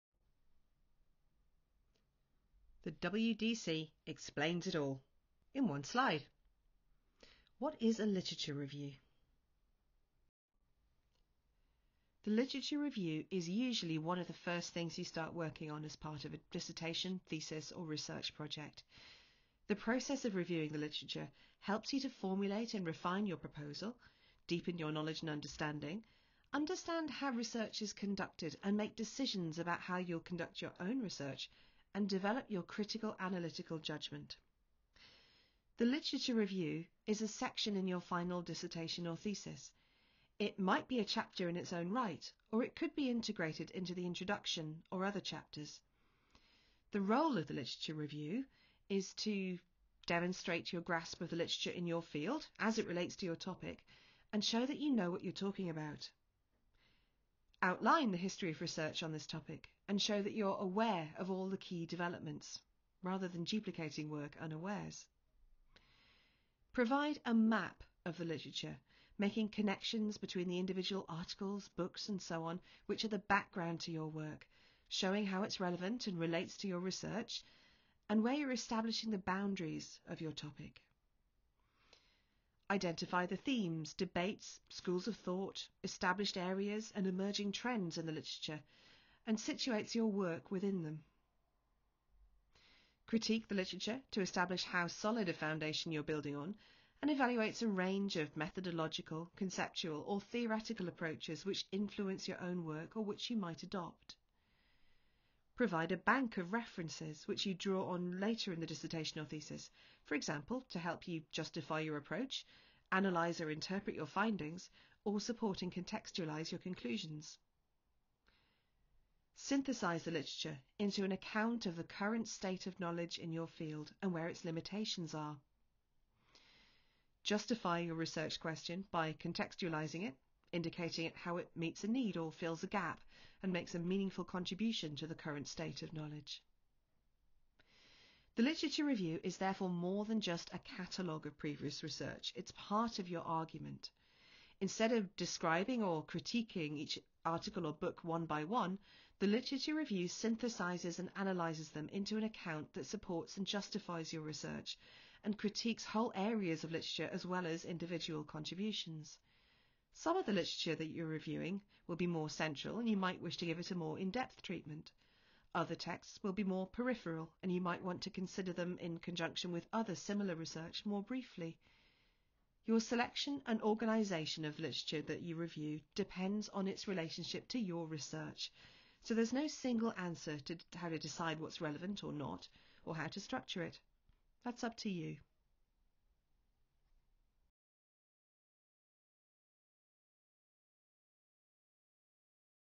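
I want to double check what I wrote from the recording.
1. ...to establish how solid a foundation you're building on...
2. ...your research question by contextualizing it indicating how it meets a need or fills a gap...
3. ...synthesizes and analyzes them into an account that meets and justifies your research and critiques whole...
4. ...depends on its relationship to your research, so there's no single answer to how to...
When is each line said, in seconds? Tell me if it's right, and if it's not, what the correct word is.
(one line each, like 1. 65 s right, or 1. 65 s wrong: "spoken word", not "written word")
1. 94 s right
2. 127 s right
3. 150 s wrong: "supports", not "meets"
4. 175 s right.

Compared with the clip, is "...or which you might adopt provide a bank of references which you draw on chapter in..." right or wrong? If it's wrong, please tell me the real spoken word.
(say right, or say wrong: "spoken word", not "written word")
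wrong: "later", not "chapter".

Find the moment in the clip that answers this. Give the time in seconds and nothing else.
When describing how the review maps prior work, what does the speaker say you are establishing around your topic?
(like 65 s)
79 s.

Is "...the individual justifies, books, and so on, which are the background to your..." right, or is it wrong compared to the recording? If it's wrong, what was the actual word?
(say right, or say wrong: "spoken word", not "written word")
wrong: "articles", not "justifies".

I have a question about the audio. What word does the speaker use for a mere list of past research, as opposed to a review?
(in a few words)
catalogue.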